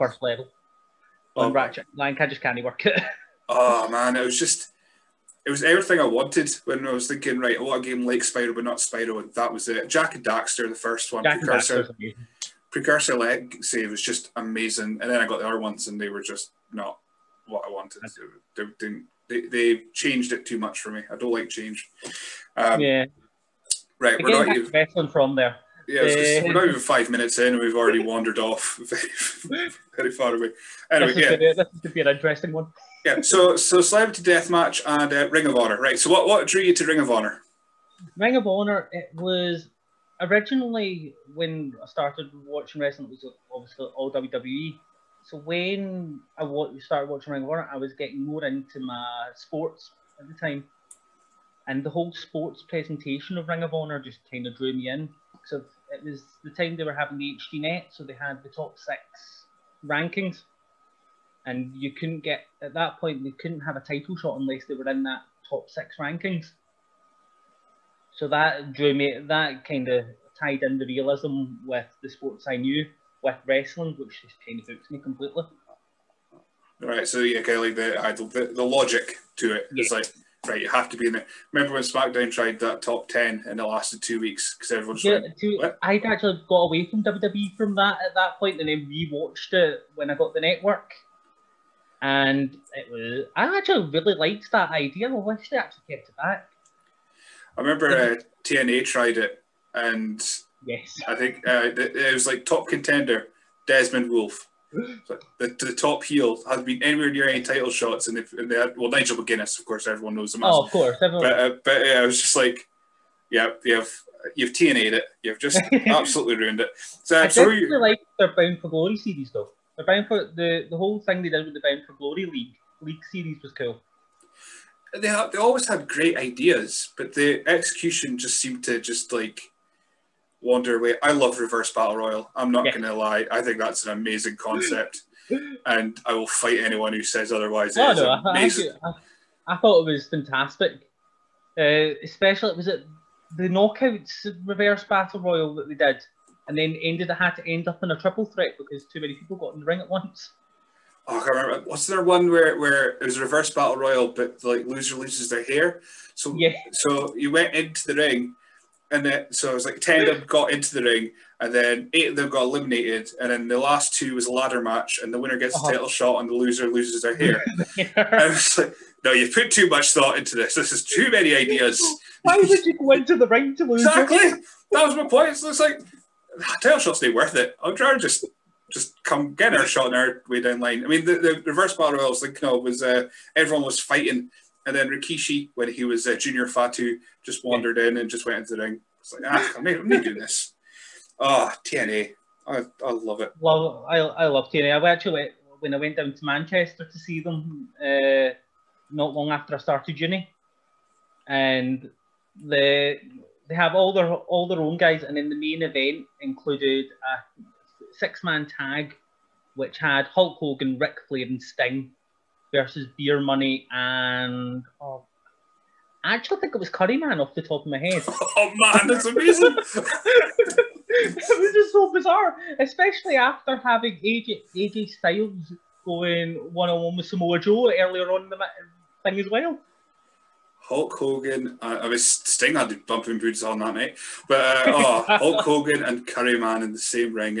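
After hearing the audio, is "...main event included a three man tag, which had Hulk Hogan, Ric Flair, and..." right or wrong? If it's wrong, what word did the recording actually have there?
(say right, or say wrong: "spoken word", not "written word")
wrong: "six", not "three".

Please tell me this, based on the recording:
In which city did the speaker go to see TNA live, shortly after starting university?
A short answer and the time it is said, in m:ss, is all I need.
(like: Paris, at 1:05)
Manchester, at 3:16.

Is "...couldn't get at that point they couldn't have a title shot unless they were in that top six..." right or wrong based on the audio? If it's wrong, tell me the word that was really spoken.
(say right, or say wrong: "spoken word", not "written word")
right.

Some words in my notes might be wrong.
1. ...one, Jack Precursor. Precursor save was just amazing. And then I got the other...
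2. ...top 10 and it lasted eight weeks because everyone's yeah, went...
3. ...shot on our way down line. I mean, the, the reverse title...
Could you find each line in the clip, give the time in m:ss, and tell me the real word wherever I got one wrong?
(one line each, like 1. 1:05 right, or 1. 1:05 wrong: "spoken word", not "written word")
1. 0:11 right
2. 1:22 wrong: "two", not "eight"
3. 2:59 wrong: "battle", not "title".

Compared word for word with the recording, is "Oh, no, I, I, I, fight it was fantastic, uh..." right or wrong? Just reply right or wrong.
wrong.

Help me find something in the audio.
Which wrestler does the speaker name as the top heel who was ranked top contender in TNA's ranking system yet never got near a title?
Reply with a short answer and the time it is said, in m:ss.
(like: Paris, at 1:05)
Desmond Wolfe, at 1:43.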